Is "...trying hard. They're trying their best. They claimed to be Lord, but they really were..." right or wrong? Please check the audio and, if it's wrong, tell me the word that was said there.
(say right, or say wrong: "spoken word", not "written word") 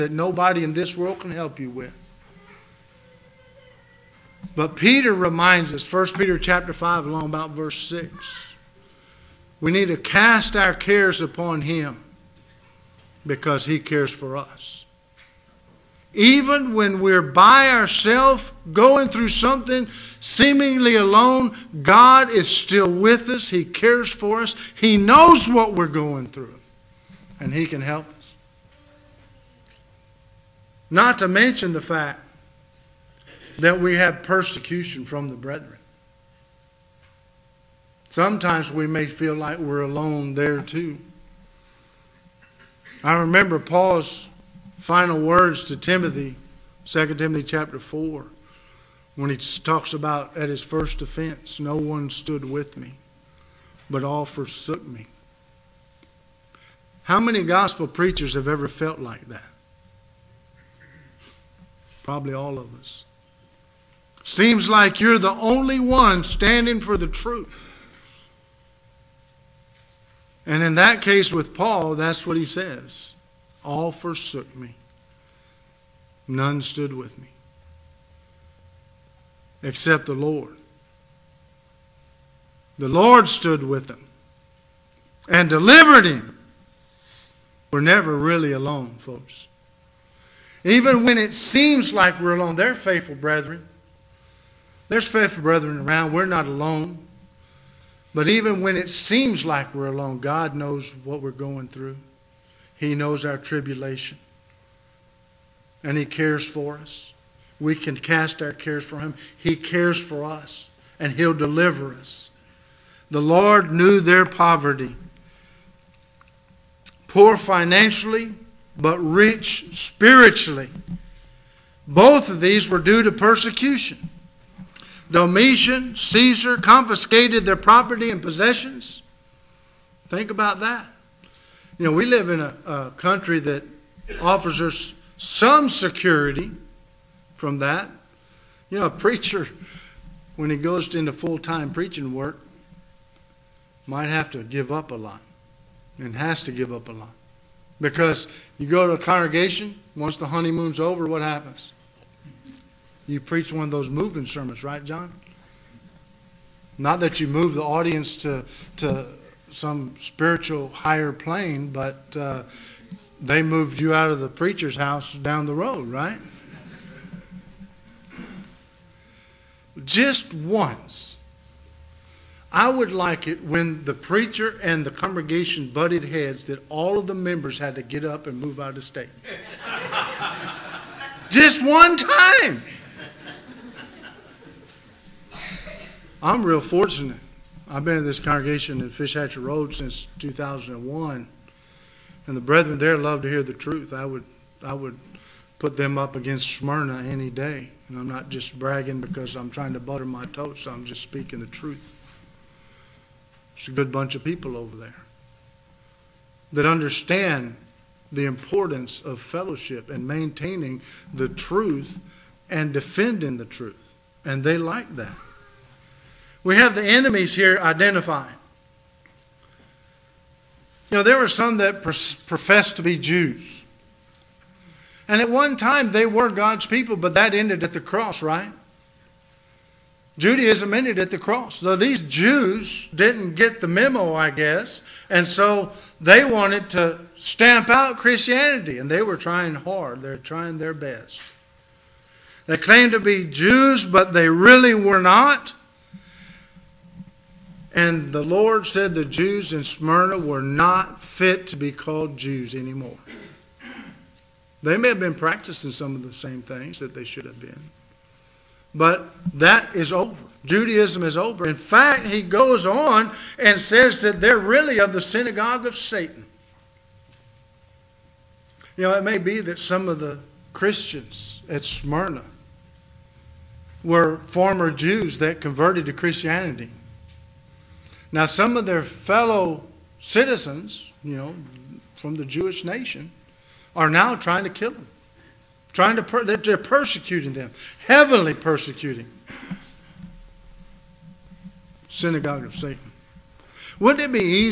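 wrong: "Jews", not "Lord".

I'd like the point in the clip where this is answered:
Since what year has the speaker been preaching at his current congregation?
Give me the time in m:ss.
3:10.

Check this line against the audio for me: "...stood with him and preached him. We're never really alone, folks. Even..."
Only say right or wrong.
wrong.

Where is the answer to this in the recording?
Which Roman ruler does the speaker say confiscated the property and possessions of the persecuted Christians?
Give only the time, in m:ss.
2:05.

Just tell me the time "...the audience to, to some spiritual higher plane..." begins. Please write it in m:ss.
2:37.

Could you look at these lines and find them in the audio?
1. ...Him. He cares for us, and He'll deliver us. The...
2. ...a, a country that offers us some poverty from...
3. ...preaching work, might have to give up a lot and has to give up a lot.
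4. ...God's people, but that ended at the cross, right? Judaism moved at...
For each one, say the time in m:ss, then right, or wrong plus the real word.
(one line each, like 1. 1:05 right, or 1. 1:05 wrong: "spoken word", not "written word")
1. 1:48 right
2. 2:12 wrong: "security", not "poverty"
3. 2:21 right
4. 3:46 wrong: "ended", not "moved".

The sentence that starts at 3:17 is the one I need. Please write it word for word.
And I'm not just bragging because I'm trying to butter my toast.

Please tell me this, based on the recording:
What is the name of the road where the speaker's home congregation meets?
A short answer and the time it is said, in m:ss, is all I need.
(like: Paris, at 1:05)
Fish Hatchery Road, at 3:08.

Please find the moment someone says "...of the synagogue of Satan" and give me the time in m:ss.
4:24.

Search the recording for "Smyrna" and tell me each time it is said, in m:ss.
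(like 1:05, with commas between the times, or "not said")
3:16, 4:09, 4:31.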